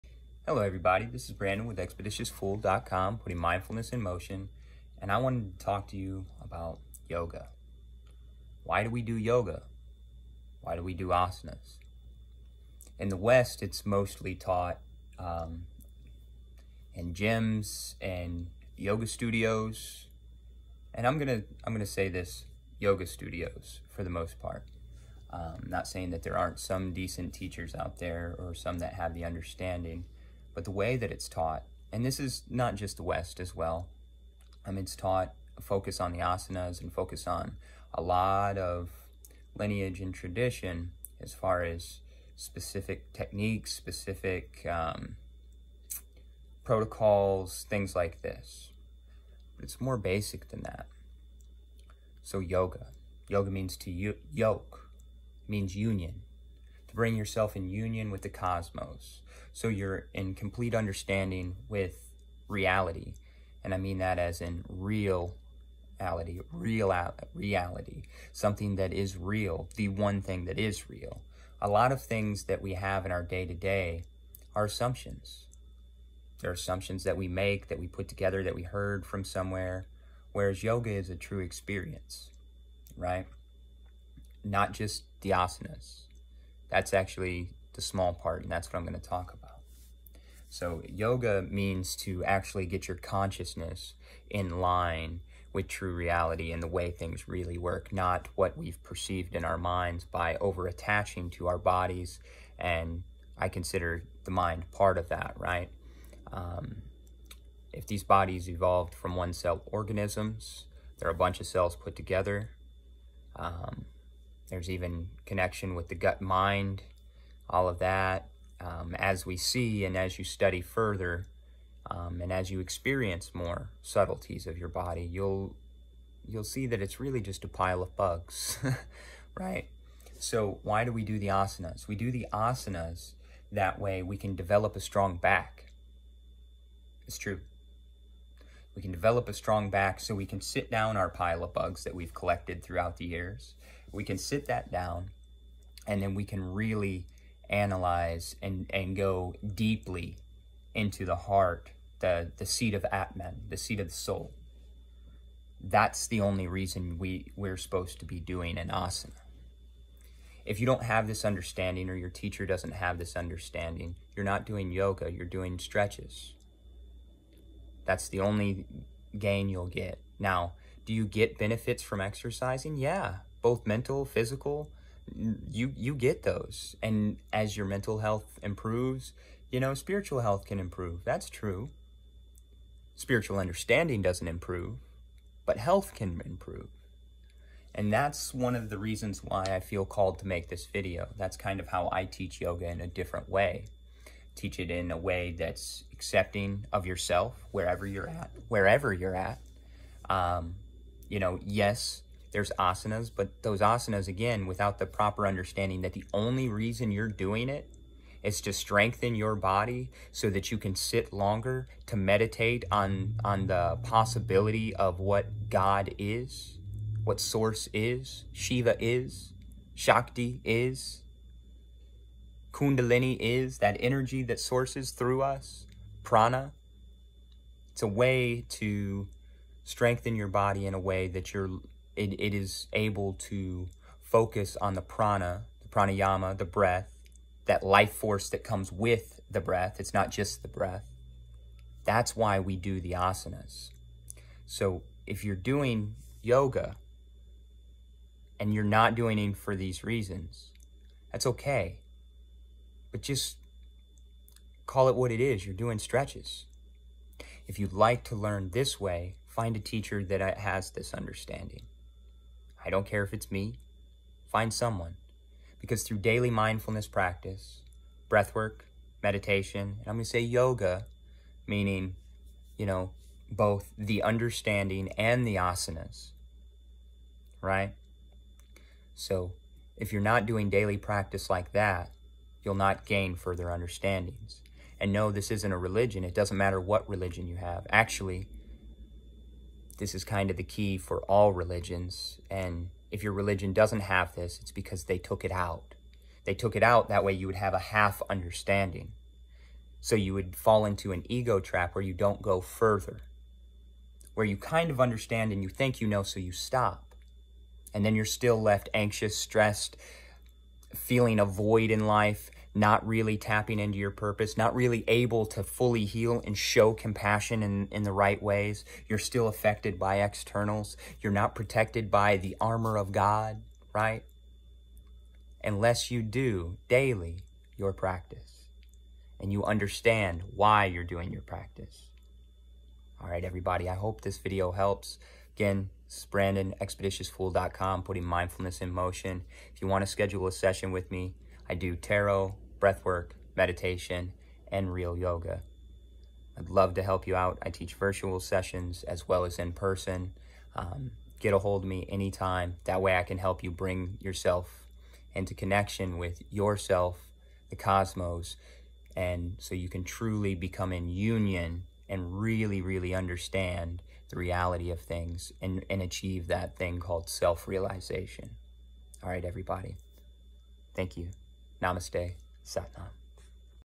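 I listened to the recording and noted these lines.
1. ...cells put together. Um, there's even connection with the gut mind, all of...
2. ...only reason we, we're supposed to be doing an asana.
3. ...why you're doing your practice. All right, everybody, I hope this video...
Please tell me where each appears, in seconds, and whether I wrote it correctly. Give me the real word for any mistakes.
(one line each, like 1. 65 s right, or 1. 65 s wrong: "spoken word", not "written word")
1. 111 s right
2. 156 s right
3. 330 s right.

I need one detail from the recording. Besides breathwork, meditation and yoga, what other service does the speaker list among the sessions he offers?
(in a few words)
Tarot.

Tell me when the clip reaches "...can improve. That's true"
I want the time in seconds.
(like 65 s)
180 s.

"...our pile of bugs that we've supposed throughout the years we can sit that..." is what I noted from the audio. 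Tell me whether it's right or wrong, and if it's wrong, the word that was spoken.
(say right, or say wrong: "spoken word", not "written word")
wrong: "collected", not "supposed".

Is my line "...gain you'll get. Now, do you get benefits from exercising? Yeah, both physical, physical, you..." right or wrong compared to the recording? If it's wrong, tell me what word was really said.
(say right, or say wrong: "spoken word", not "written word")
wrong: "mental", not "physical".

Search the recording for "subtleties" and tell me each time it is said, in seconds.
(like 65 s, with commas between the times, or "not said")
123 s.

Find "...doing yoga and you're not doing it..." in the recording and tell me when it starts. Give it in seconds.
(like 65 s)
245 s.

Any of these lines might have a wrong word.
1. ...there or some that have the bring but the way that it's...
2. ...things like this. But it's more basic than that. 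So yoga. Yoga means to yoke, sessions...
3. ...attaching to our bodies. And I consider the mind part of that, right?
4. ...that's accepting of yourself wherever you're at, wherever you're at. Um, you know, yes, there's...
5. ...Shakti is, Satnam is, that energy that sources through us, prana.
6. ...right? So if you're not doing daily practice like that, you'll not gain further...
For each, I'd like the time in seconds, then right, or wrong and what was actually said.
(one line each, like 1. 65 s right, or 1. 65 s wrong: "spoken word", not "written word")
1. 27 s wrong: "understanding", not "bring"
2. 47 s wrong: "means", not "sessions"
3. 100 s right
4. 195 s right
5. 219 s wrong: "Kundalini", not "Satnam"
6. 277 s right.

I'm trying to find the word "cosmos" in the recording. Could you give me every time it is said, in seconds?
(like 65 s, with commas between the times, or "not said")
58 s, 357 s.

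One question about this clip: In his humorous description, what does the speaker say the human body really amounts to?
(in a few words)
A pile of bugs.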